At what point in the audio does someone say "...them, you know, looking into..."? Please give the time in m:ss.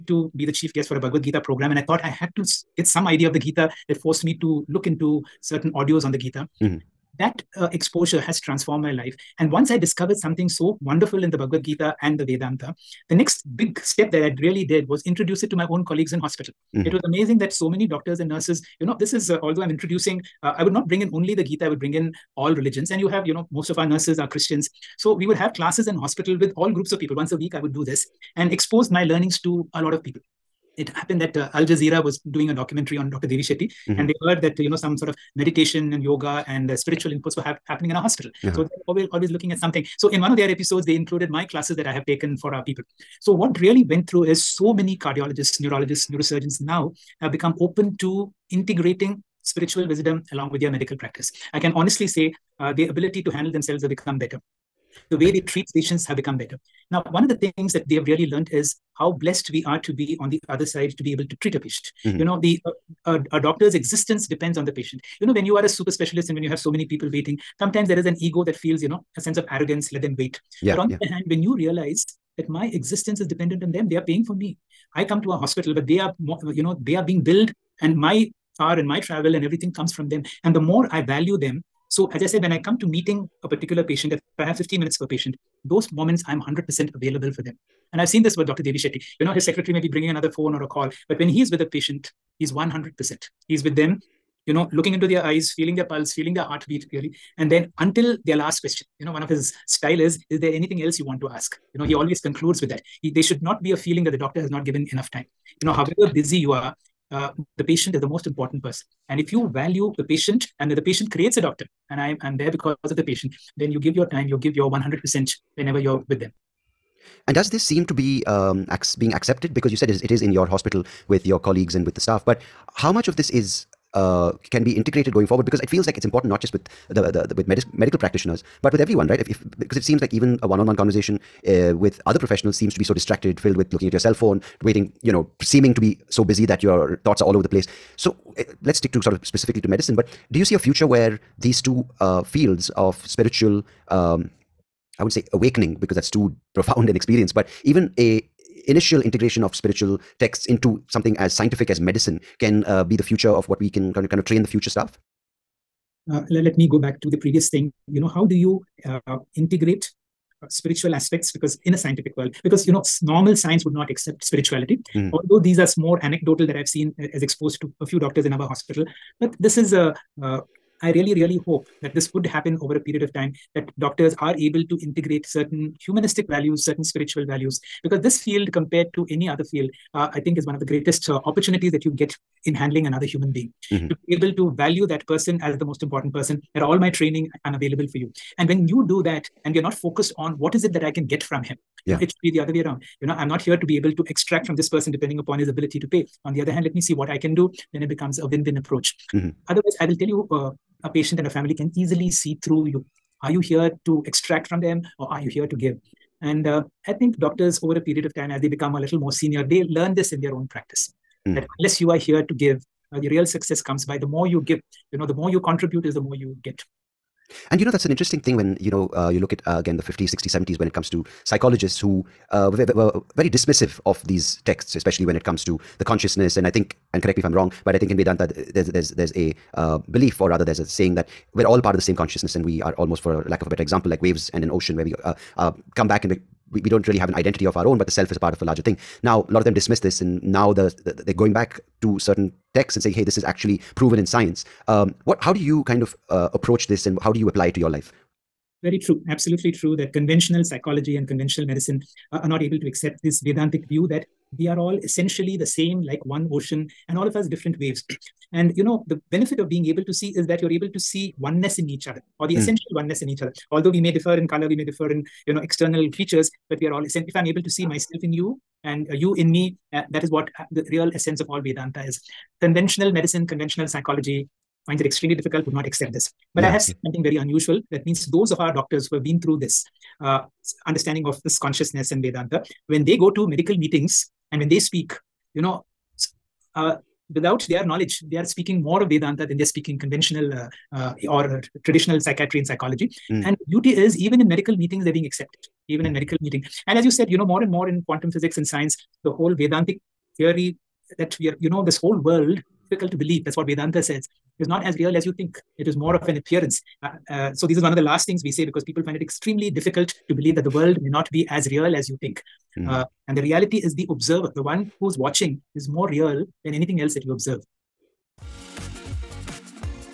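1:33.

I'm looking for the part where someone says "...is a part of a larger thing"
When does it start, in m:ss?
3:58.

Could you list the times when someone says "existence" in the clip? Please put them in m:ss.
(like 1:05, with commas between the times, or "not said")
1:03, 1:12.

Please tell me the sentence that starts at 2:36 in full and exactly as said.
Uh, let, let, me go back to the previous thing.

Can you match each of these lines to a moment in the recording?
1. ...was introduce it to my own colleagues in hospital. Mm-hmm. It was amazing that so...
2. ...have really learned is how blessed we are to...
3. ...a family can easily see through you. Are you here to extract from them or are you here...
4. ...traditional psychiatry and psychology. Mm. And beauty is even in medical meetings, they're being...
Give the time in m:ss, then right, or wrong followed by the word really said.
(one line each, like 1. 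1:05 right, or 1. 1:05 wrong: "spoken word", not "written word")
1. 0:14 right
2. 0:57 right
3. 3:21 right
4. 4:51 right.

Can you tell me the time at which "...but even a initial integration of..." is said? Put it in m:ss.
2:27.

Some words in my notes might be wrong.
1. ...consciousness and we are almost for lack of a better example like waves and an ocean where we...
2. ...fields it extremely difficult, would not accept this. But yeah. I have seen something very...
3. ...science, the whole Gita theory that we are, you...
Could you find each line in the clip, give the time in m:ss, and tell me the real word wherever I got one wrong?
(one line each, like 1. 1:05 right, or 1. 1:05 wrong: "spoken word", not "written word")
1. 3:51 right
2. 4:34 wrong: "finds", not "fields"
3. 4:58 wrong: "Vedantic", not "Gita".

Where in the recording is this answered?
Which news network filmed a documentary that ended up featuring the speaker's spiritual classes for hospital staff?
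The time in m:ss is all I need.
0:31.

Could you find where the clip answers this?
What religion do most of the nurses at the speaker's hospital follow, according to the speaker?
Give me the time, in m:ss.
0:24.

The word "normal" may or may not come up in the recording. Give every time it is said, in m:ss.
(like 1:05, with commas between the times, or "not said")
2:43.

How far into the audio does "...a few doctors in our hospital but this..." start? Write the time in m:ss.
2:47.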